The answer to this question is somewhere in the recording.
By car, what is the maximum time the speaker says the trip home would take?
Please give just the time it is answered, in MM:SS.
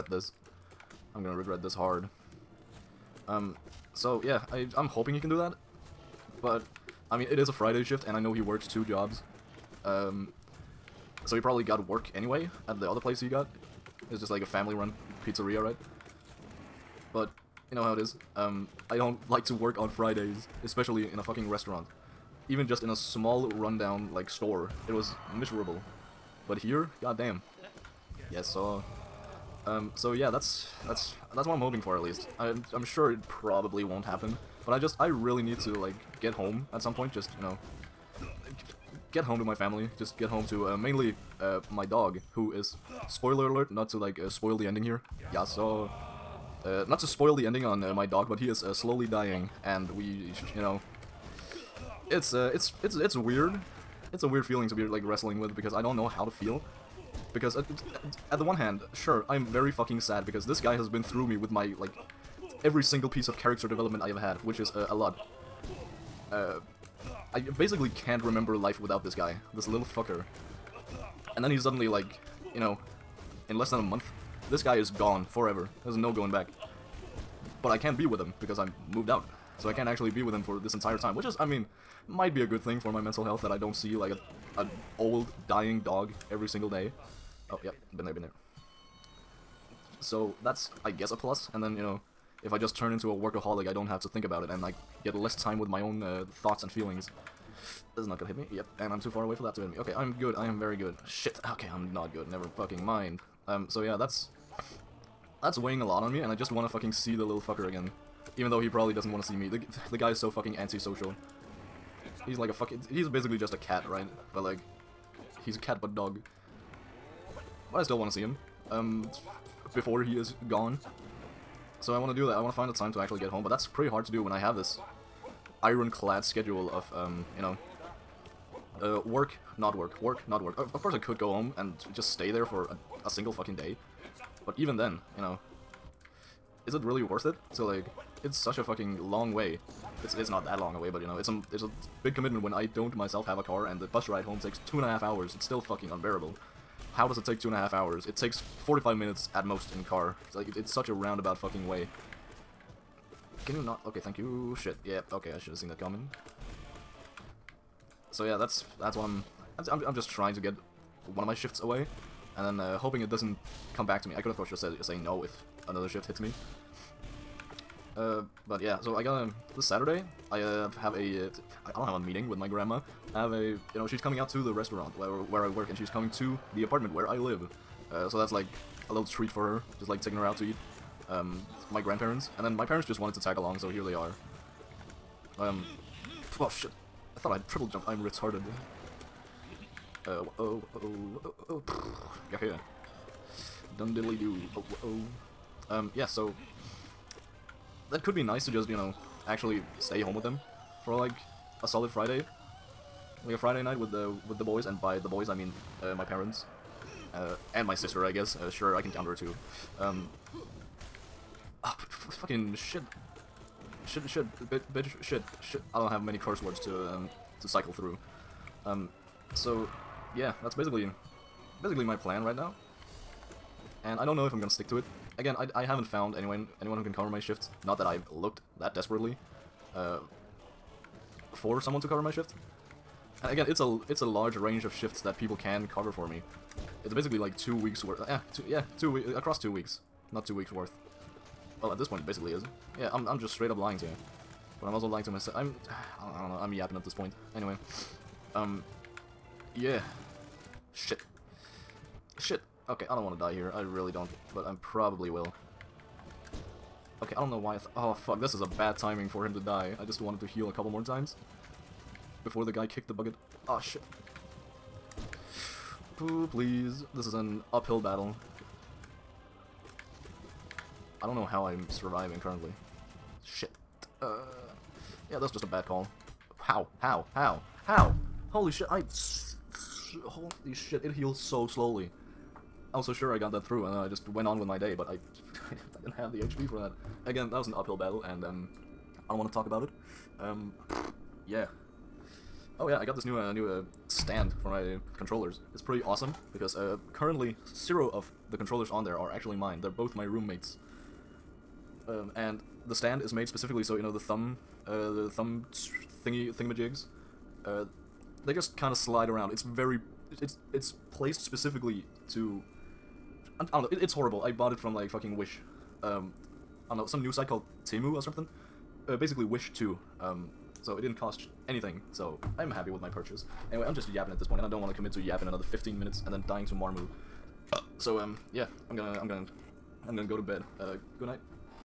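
02:28.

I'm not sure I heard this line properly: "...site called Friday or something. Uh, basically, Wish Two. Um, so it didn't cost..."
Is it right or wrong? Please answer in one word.
wrong.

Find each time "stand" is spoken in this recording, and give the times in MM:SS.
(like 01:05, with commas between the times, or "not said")
04:53, 05:02.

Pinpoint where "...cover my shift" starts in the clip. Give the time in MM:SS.
03:51.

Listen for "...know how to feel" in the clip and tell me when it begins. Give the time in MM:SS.
00:55.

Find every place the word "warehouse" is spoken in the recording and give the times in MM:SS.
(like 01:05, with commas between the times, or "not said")
not said.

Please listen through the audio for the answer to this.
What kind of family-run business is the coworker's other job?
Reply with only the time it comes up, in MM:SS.
00:14.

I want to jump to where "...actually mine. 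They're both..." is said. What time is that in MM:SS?
04:59.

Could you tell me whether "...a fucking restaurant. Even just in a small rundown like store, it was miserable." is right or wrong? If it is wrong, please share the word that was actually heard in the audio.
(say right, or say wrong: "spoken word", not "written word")
right.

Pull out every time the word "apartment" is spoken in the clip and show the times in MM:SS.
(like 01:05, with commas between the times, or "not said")
02:56.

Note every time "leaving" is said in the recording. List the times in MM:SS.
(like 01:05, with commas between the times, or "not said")
not said.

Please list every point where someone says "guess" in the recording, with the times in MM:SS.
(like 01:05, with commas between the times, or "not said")
01:30, 03:28.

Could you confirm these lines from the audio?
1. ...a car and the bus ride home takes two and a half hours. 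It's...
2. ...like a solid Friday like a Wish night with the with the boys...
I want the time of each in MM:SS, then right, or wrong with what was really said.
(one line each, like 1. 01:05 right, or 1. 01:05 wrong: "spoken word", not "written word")
1. 02:23 right
2. 03:20 wrong: "Friday", not "Wish".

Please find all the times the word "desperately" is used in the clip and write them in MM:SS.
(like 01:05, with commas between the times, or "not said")
03:48.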